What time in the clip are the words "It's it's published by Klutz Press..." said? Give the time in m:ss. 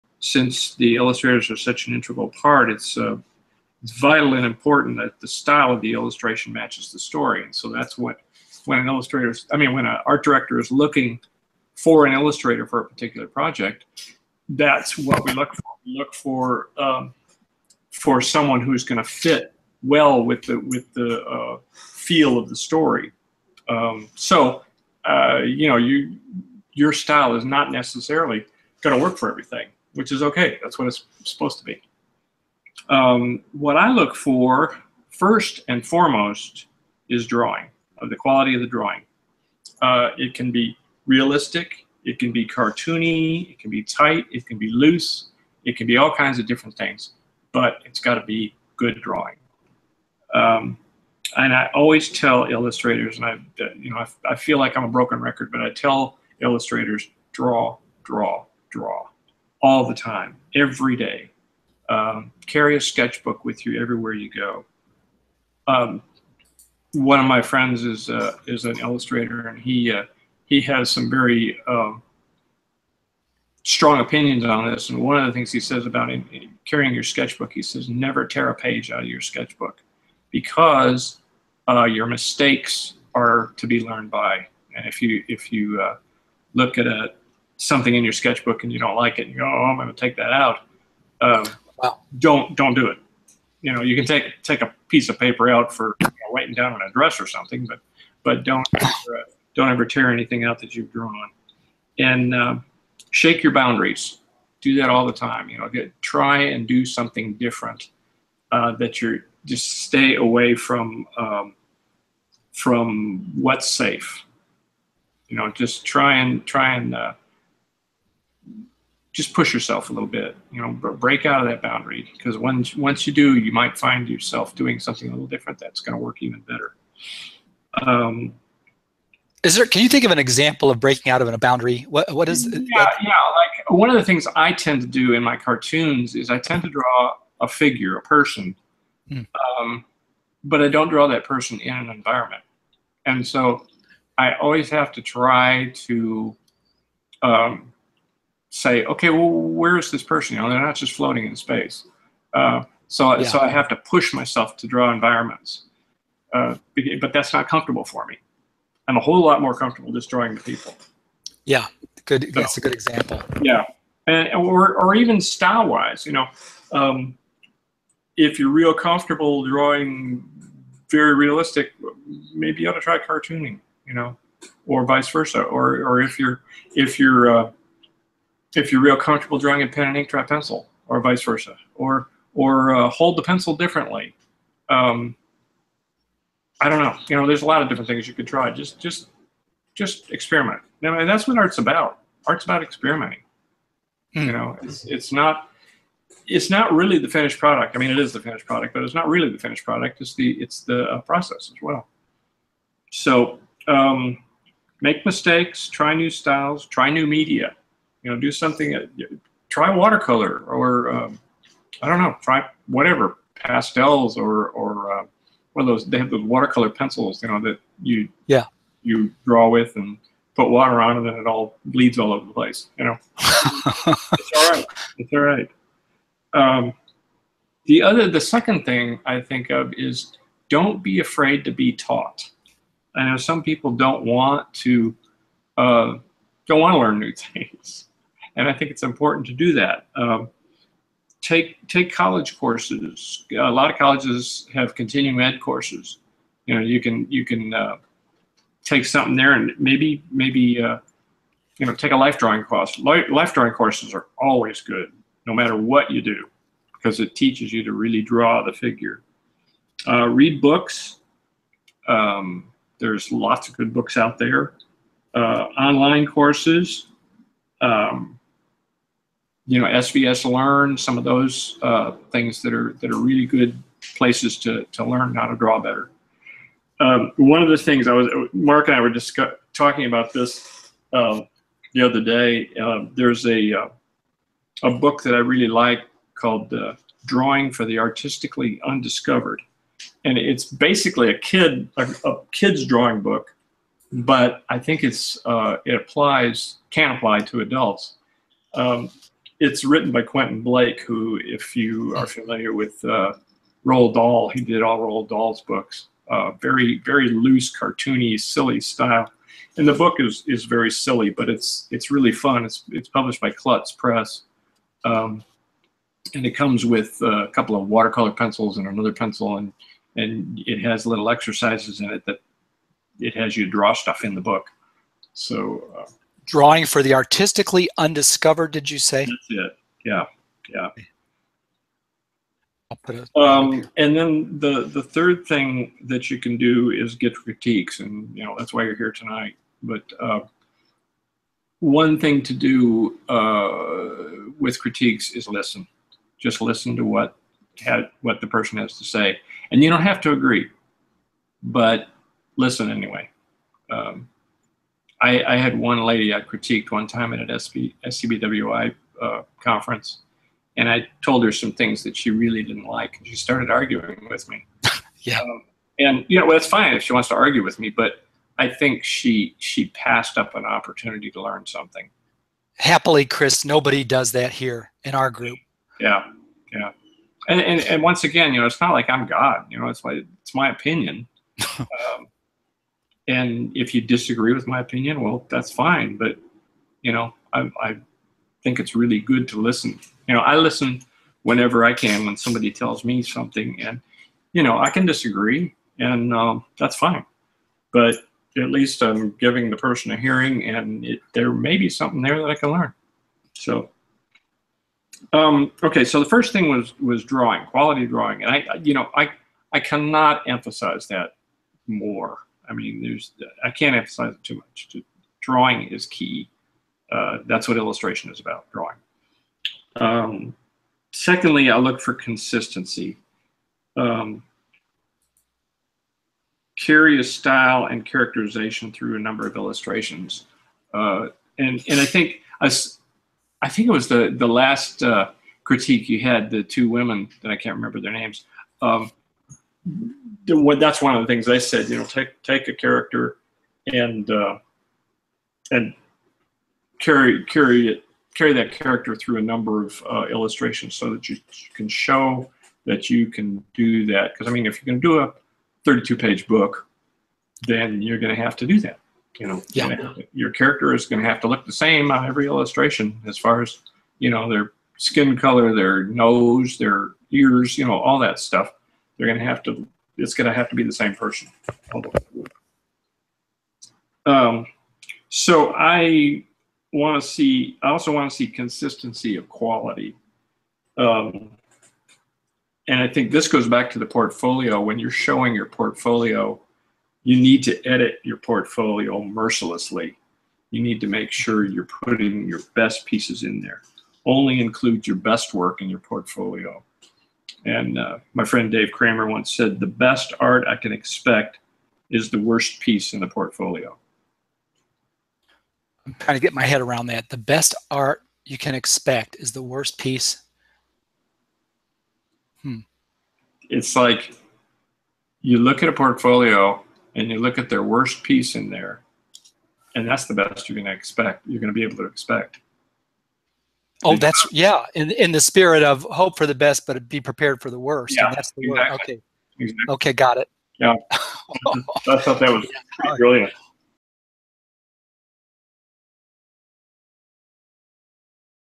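5:12.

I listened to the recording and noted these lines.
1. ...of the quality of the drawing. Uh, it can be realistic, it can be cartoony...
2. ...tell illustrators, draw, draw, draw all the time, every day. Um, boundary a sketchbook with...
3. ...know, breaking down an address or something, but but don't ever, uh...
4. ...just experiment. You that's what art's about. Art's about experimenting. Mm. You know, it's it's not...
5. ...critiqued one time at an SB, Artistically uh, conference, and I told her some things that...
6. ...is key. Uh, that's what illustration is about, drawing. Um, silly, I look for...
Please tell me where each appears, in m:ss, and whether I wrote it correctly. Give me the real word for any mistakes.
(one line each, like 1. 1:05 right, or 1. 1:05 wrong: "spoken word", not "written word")
1. 0:37 right
2. 0:55 wrong: "carry", not "boundary"
3. 1:36 wrong: "writing", not "breaking"
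4. 3:09 right
5. 5:56 wrong: "SCBWI", not "Artistically"
6. 6:55 wrong: "secondly", not "silly".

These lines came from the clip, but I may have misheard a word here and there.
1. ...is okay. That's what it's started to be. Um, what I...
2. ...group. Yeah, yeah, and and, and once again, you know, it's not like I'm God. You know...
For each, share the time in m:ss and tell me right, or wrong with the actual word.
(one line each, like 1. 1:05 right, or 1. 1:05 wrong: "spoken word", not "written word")
1. 0:30 wrong: "supposed", not "started"
2. 6:15 right.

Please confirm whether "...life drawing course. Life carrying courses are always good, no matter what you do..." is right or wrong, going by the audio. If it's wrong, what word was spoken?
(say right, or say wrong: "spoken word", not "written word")
wrong: "drawing", not "carrying".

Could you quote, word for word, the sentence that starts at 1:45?
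You know, get, try and do something different uh, that you're just stay away from um, from what's safe.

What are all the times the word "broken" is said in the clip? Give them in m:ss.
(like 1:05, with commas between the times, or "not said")
0:54.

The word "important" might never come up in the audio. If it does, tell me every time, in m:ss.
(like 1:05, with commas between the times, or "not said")
0:04, 3:58.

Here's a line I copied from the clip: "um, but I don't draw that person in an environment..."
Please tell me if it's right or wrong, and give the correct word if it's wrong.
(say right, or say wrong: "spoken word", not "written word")
right.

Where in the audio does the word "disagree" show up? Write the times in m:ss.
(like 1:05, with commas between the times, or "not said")
6:23, 6:34.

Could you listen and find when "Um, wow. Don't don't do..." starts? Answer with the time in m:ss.
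1:31.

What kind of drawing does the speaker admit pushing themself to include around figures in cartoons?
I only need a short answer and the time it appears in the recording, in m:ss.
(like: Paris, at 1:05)
Environments, at 2:33.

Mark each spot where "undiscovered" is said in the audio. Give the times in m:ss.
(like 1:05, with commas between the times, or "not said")
4:48, 5:27.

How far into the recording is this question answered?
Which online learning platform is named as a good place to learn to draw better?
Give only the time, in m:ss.
4:29.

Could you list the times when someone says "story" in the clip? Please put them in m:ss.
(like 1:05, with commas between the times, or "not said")
0:06, 0:22.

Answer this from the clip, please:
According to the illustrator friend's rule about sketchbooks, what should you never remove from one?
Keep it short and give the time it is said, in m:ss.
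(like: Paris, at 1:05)
A page, at 1:17.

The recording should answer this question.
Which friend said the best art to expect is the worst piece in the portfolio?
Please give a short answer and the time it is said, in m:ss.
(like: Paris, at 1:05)
Dave Kramer, at 8:18.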